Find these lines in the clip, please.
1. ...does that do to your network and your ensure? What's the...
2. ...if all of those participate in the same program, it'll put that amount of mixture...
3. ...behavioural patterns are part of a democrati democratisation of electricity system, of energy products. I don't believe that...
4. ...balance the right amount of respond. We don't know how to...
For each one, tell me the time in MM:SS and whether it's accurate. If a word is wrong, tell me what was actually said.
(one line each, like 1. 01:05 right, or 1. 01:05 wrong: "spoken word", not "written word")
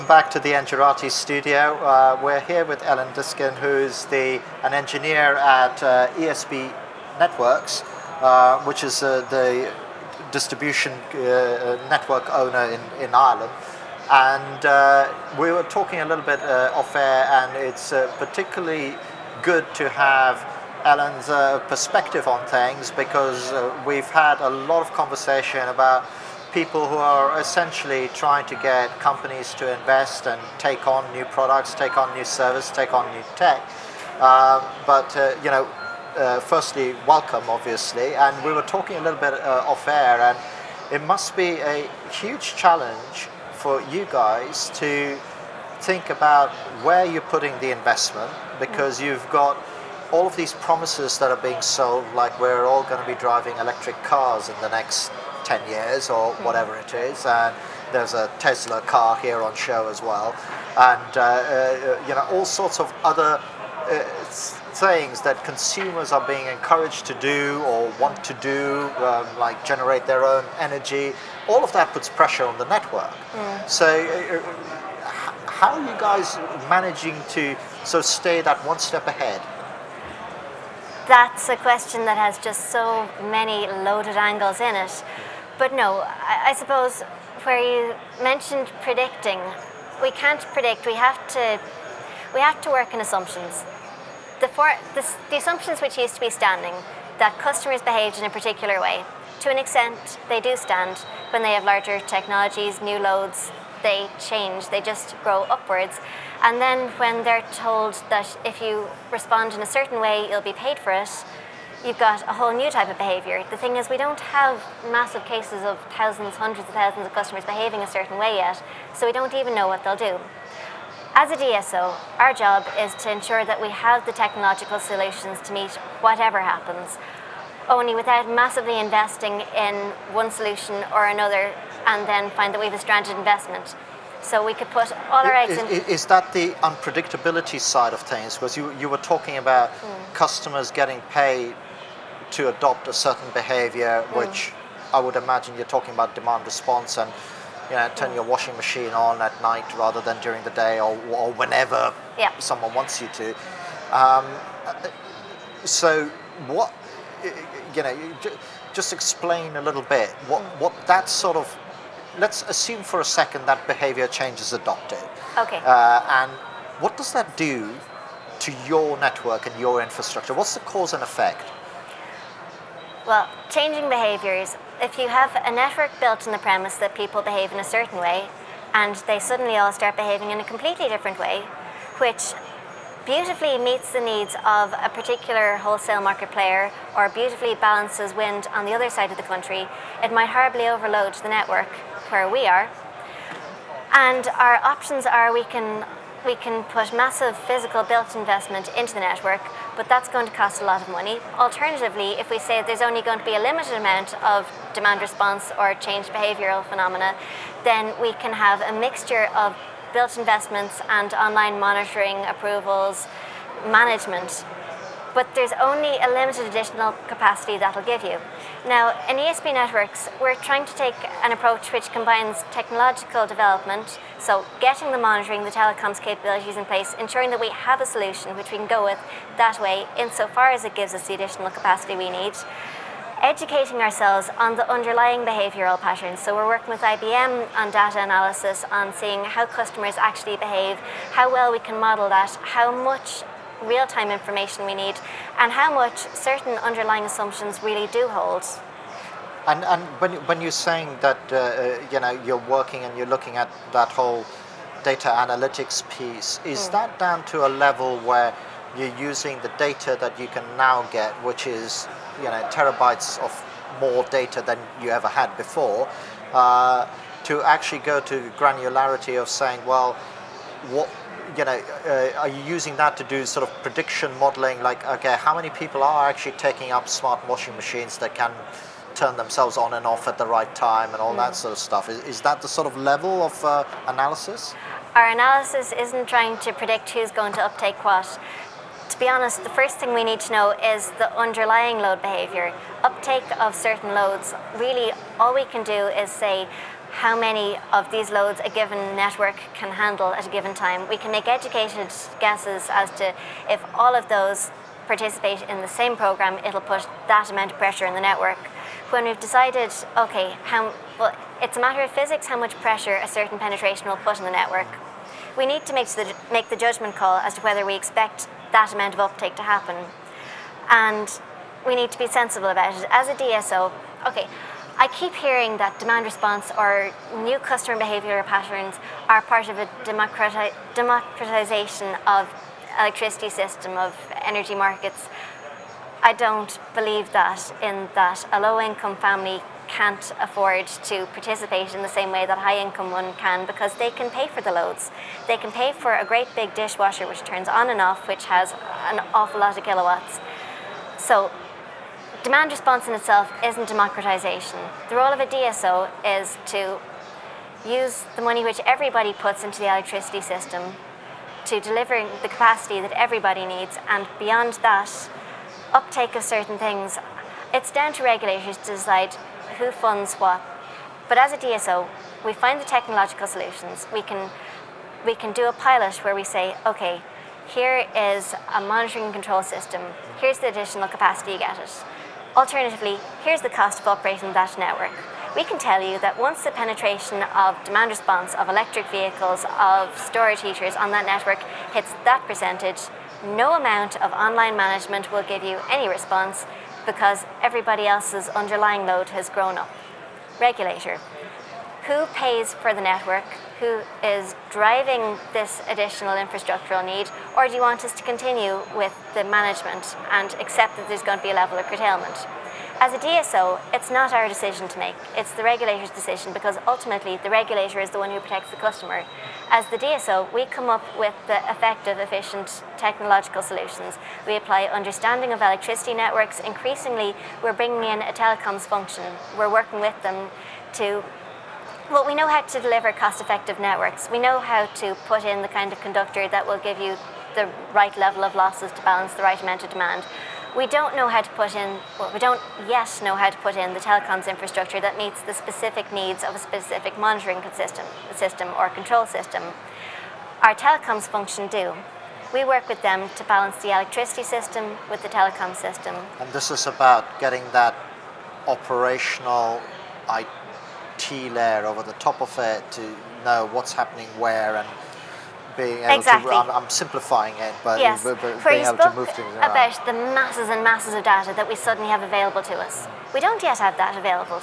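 1. 02:46 wrong: "infrastructure", not "ensure"
2. 05:03 wrong: "pressure", not "mixture"
3. 05:27 wrong: "markets", not "products"
4. 07:18 wrong: "demand", not "respond".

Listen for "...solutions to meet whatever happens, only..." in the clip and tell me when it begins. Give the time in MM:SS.
02:04.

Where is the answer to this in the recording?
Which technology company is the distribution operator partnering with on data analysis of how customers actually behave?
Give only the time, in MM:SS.
03:56.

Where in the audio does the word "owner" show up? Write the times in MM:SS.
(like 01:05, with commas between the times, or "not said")
00:12.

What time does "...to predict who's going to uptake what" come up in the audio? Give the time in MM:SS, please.
04:46.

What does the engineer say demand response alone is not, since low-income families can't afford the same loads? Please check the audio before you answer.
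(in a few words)
democratization.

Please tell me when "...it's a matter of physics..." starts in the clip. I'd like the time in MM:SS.
05:11.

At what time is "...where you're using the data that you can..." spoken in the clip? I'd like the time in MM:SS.
04:17.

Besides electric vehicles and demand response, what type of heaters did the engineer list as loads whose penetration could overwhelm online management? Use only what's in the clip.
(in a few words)
storage heaters.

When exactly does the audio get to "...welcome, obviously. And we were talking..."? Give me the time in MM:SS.
00:37.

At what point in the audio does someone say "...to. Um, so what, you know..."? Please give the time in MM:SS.
02:33.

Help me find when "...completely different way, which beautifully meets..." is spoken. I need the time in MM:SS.
03:00.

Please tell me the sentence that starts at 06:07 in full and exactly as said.
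It's down to regulators to decide who funds what.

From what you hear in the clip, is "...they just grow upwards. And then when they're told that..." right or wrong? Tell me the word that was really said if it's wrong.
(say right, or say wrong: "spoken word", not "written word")
right.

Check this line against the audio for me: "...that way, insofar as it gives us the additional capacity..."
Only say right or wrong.
right.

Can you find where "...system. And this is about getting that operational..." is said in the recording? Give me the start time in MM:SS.
07:35.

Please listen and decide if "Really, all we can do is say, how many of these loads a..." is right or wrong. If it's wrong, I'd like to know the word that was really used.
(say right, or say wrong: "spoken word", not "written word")
right.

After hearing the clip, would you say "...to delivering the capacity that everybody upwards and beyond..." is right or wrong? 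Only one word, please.
wrong.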